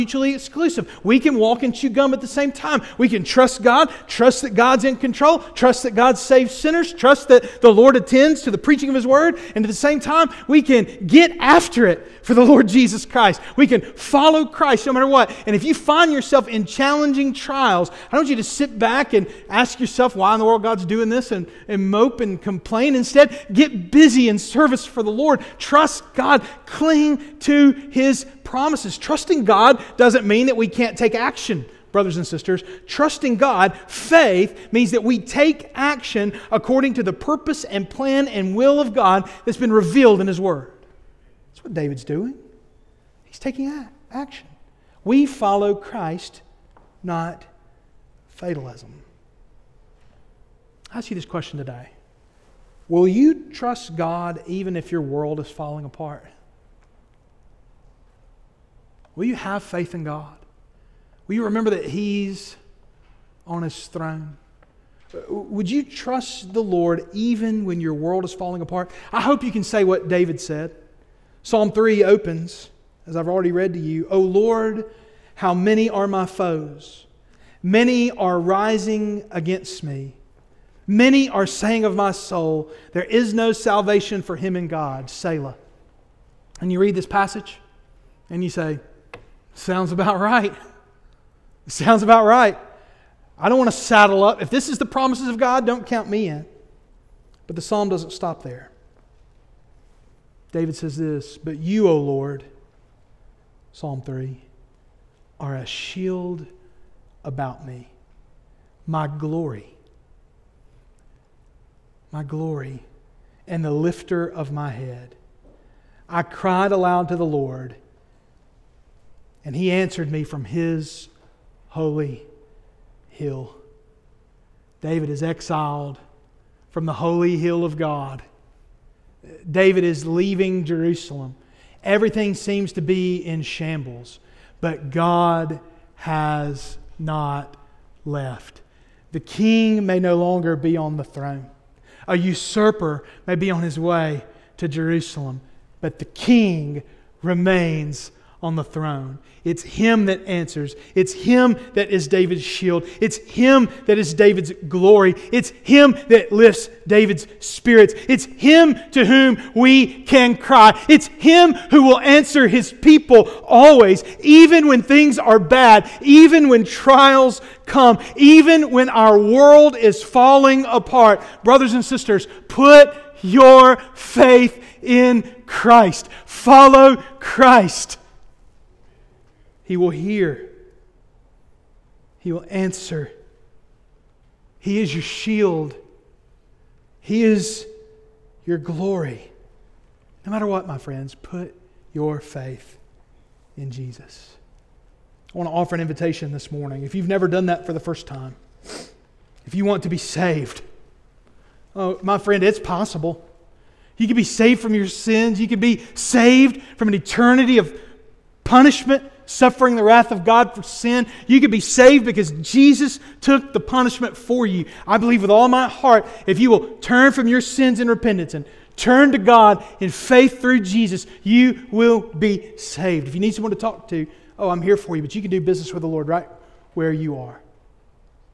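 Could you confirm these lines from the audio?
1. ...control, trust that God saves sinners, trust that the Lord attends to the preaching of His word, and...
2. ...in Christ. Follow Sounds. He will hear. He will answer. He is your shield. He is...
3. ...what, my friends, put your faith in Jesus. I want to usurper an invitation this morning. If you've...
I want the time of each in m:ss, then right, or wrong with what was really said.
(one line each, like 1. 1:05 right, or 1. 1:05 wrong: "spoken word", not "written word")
1. 0:04 right
2. 2:54 wrong: "Christ", not "Sounds"
3. 3:10 wrong: "offer", not "usurper".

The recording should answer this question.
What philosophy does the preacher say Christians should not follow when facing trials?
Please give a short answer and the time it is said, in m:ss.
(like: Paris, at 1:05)
Fatalism, at 0:48.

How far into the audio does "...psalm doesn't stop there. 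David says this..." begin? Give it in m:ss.
1:37.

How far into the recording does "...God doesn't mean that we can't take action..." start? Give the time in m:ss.
0:29.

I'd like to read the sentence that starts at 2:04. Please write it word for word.
David is exiled from the holy hill of God.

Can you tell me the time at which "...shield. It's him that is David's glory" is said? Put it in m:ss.
2:32.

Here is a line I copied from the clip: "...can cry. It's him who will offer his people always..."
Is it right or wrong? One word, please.
wrong.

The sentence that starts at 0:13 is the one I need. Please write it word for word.
We can follow Christ no matter what.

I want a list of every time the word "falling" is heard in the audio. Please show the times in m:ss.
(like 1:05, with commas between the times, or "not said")
0:55, 1:08, 2:50.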